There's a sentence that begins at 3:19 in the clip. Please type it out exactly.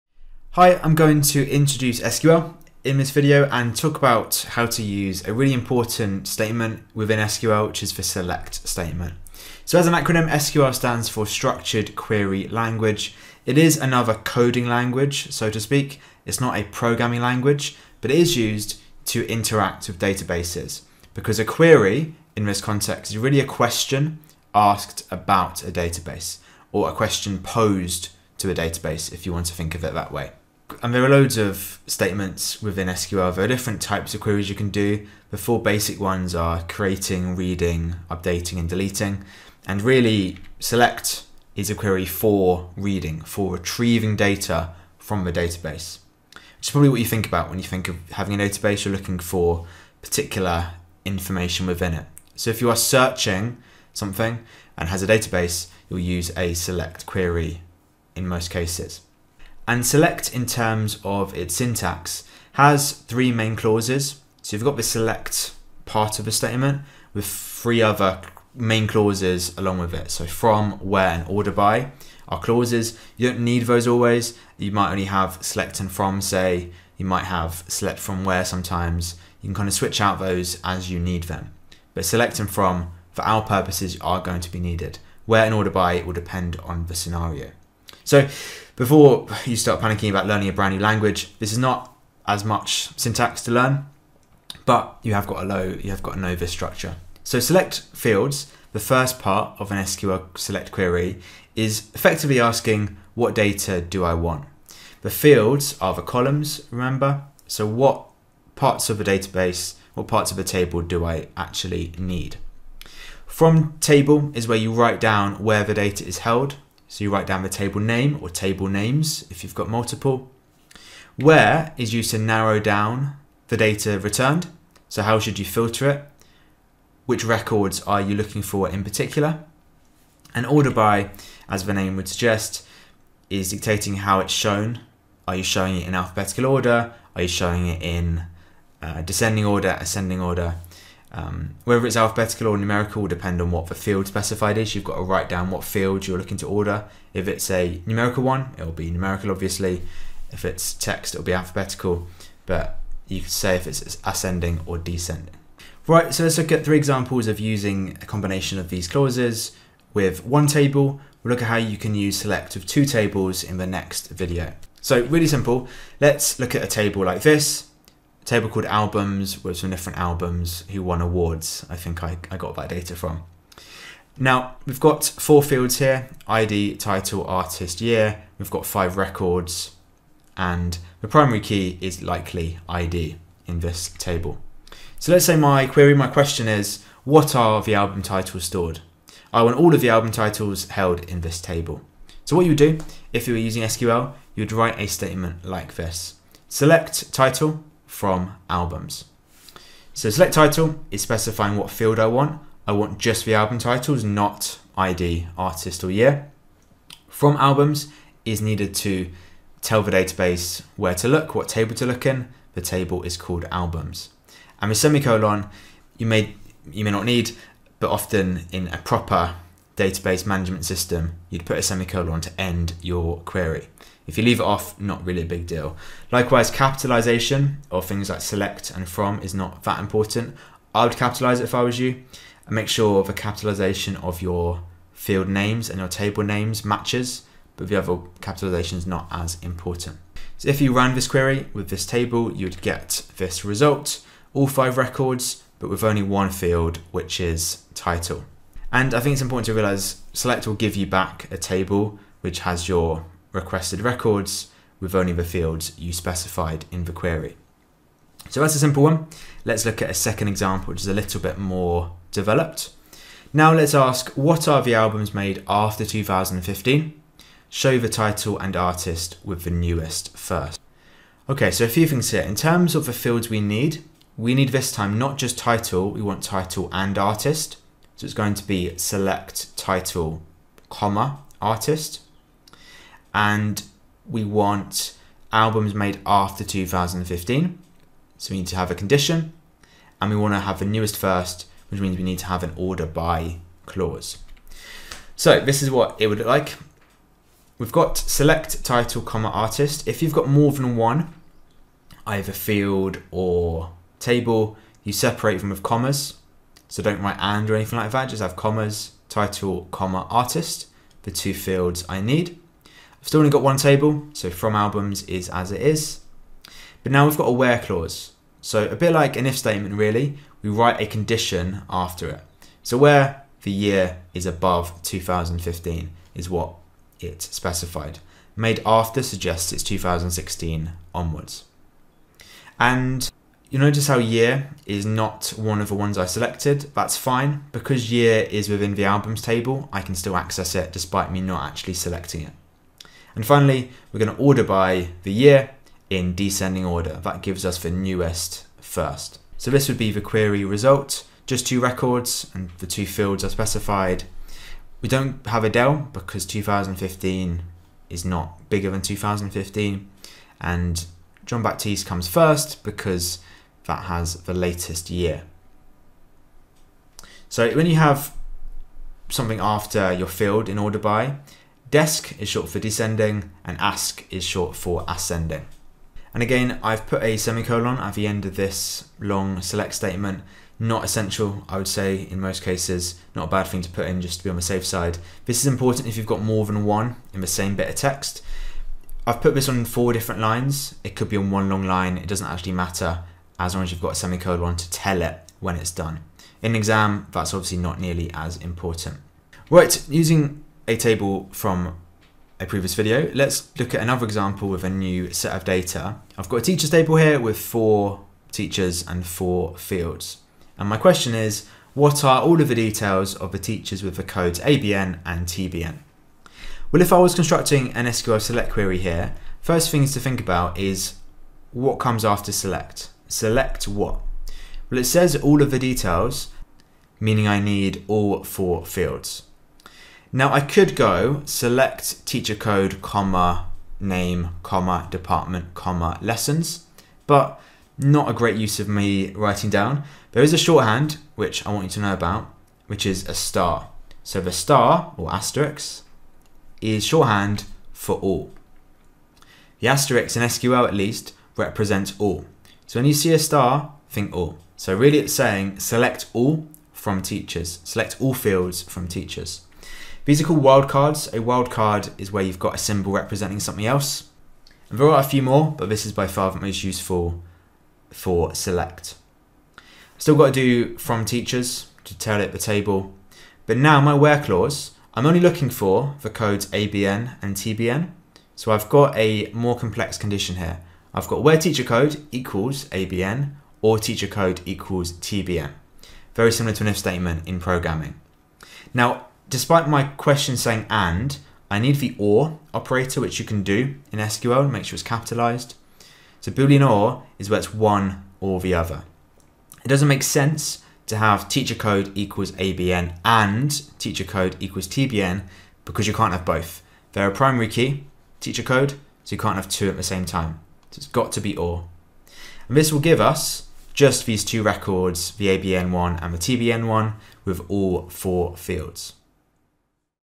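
So select title is specifying what field I want.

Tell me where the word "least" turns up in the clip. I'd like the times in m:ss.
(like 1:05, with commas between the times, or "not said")
7:30.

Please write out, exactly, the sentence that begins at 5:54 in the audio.
We don't have Adele because 2015 is not bigger than 2015 and Jon Batiste comes first because that has the latest year.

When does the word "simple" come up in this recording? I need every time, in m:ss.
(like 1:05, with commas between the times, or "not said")
2:45, 4:18.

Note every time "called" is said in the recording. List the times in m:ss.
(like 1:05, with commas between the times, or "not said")
2:48, 3:33, 7:40.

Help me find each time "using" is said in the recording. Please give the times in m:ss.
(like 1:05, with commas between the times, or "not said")
2:37, 3:13, 6:39.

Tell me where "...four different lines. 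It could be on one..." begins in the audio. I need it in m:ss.
6:29.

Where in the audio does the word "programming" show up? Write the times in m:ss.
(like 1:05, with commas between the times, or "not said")
0:16, 8:07.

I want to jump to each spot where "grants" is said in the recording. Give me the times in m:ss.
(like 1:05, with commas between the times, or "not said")
not said.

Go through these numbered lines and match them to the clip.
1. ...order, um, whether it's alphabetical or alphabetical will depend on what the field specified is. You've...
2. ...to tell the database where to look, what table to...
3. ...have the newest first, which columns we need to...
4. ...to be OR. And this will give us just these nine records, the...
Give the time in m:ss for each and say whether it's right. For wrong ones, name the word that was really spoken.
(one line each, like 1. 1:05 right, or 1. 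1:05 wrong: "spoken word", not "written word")
1. 2:20 wrong: "numerical", not "alphabetical"
2. 3:28 right
3. 4:50 wrong: "means", not "columns"
4. 8:31 wrong: "two", not "nine".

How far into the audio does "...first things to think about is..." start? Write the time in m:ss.
6:59.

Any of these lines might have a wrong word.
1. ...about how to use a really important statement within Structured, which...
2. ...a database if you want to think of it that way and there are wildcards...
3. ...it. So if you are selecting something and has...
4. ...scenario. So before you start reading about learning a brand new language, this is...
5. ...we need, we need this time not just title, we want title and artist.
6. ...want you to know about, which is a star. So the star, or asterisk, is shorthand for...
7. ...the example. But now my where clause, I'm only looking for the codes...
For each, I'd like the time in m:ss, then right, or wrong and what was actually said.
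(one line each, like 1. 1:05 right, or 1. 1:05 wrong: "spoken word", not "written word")
1. 0:03 wrong: "SQL", not "Structured"
2. 0:28 wrong: "loads", not "wildcards"
3. 0:51 wrong: "searching", not "selecting"
4. 1:26 wrong: "panicking", not "reading"
5. 4:33 right
6. 7:21 right
7. 7:52 wrong: "table", not "example".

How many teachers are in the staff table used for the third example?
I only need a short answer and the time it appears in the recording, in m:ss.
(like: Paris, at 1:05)
4, at 6:47.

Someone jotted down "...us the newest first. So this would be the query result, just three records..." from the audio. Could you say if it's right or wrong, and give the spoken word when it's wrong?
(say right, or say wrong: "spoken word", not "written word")
wrong: "two", not "three".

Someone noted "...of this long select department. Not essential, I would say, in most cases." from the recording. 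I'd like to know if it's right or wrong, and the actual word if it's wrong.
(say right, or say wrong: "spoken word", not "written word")
wrong: "statement", not "department".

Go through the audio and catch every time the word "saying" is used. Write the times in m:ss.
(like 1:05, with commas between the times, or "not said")
7:35, 8:10.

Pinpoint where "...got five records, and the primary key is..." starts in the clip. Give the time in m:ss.
2:58.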